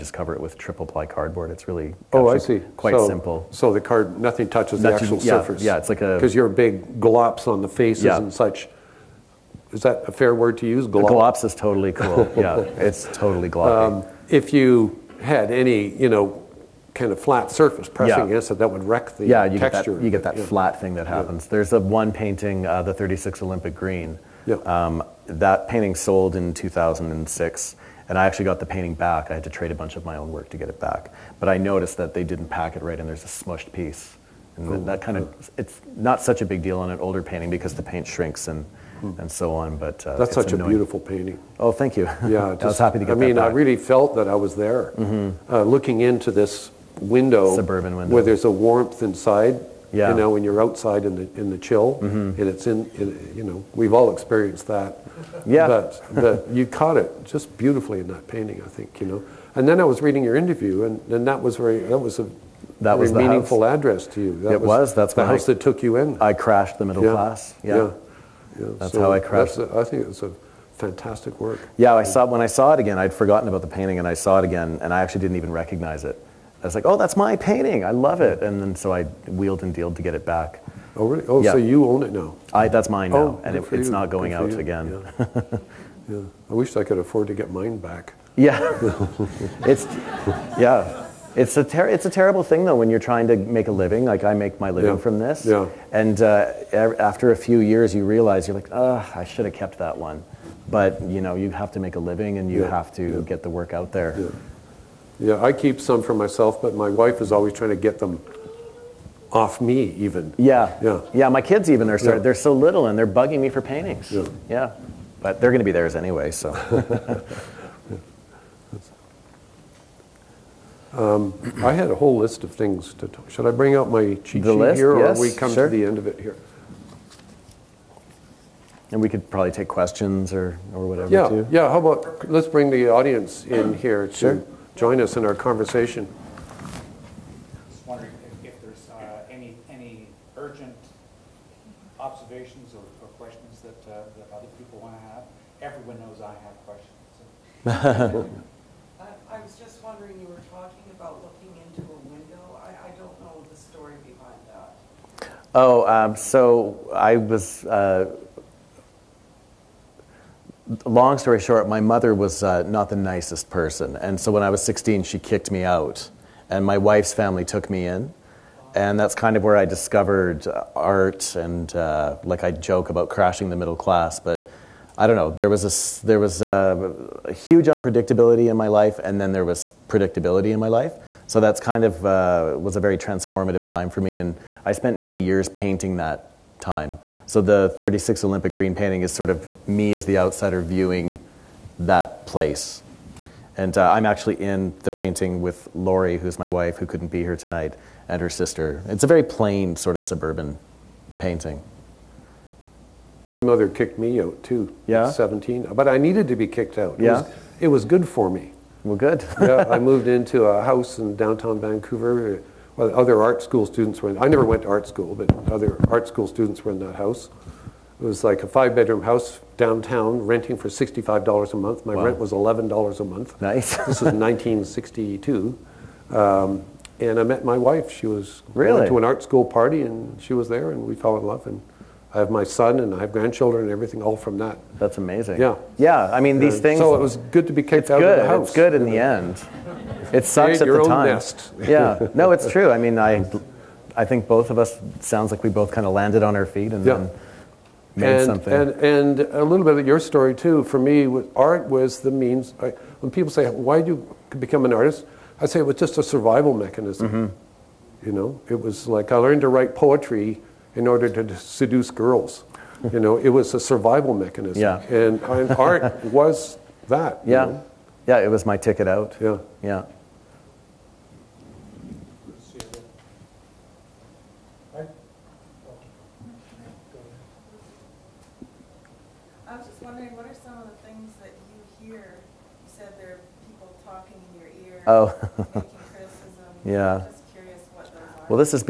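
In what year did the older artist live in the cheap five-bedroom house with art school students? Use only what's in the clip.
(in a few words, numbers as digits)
1962.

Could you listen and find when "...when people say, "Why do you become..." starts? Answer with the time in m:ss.
4:12.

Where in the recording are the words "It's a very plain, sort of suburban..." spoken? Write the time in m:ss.
3:18.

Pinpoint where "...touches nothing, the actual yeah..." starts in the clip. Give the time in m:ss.
0:04.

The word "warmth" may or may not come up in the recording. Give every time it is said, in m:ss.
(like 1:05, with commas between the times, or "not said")
0:48.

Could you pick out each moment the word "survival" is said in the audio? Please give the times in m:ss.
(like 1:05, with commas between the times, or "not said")
4:16, 4:23.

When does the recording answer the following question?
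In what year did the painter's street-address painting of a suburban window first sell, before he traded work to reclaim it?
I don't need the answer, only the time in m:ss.
0:26.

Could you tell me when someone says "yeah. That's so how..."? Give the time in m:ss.
1:08.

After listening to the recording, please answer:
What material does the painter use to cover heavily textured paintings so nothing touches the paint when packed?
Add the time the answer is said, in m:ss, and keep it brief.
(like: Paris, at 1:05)
Triple ply cardboard, at 0:00.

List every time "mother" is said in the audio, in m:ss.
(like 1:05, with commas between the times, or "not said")
2:41, 3:23.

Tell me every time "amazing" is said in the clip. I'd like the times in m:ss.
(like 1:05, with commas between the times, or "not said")
3:54.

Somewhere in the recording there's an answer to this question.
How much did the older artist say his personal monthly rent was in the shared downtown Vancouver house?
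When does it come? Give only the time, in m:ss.
3:42.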